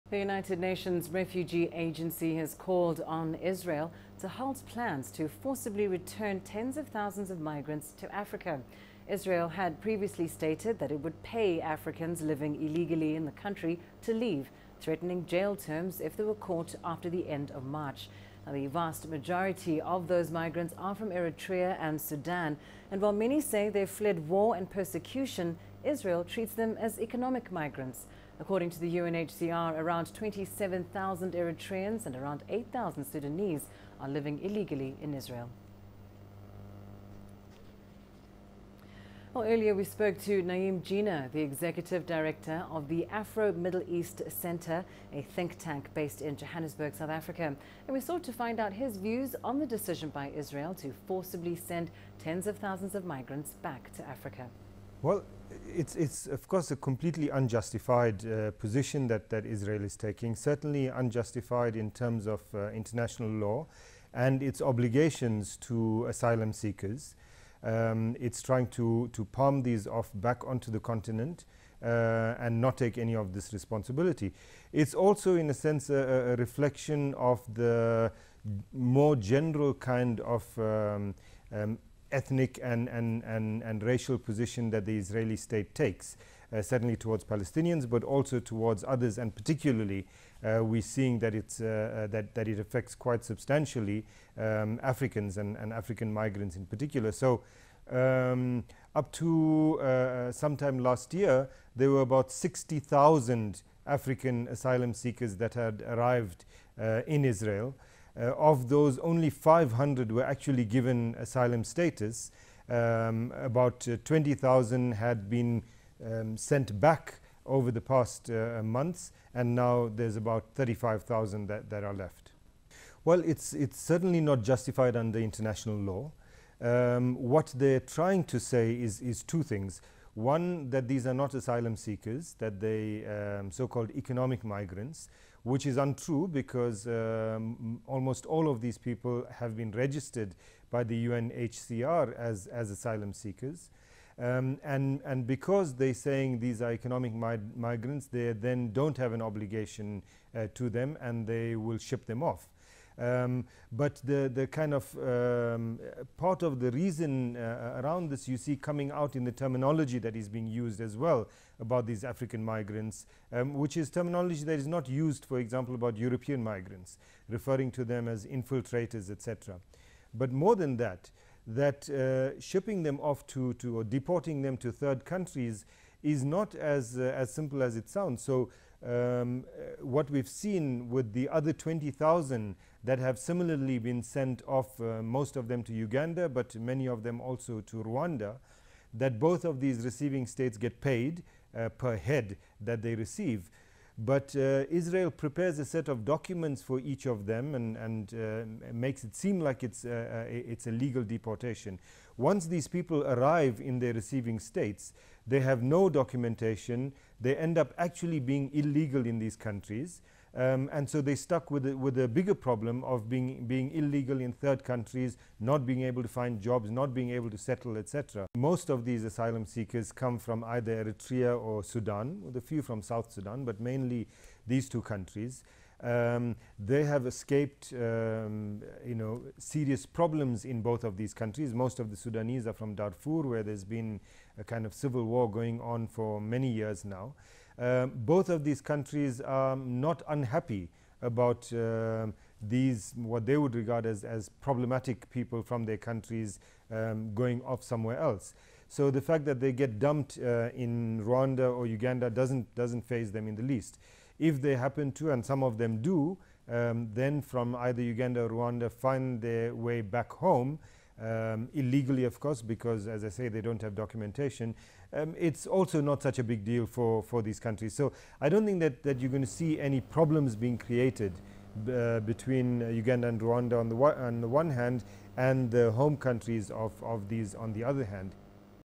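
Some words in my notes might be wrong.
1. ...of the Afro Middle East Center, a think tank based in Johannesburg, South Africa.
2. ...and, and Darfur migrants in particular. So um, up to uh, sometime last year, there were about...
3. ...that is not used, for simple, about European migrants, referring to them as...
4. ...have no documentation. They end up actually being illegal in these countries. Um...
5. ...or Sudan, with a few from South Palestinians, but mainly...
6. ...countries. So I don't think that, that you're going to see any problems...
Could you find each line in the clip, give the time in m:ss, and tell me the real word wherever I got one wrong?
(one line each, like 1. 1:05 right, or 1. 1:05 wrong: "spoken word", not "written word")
1. 0:42 right
2. 1:35 wrong: "African", not "Darfur"
3. 2:44 wrong: "example", not "simple"
4. 3:25 right
5. 3:41 wrong: "Sudan", not "Palestinians"
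6. 4:27 right.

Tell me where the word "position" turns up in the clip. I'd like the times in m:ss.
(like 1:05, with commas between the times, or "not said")
0:58, 1:24.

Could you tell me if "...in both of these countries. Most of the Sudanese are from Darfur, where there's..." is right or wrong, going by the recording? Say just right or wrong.
right.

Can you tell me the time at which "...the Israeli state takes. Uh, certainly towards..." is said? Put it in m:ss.
1:24.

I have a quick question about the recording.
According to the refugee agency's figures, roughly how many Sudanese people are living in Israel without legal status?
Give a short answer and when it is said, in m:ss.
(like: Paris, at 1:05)
8,000, at 0:32.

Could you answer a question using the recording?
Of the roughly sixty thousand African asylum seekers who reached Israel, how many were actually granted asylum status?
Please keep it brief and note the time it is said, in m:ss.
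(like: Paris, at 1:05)
500, at 1:49.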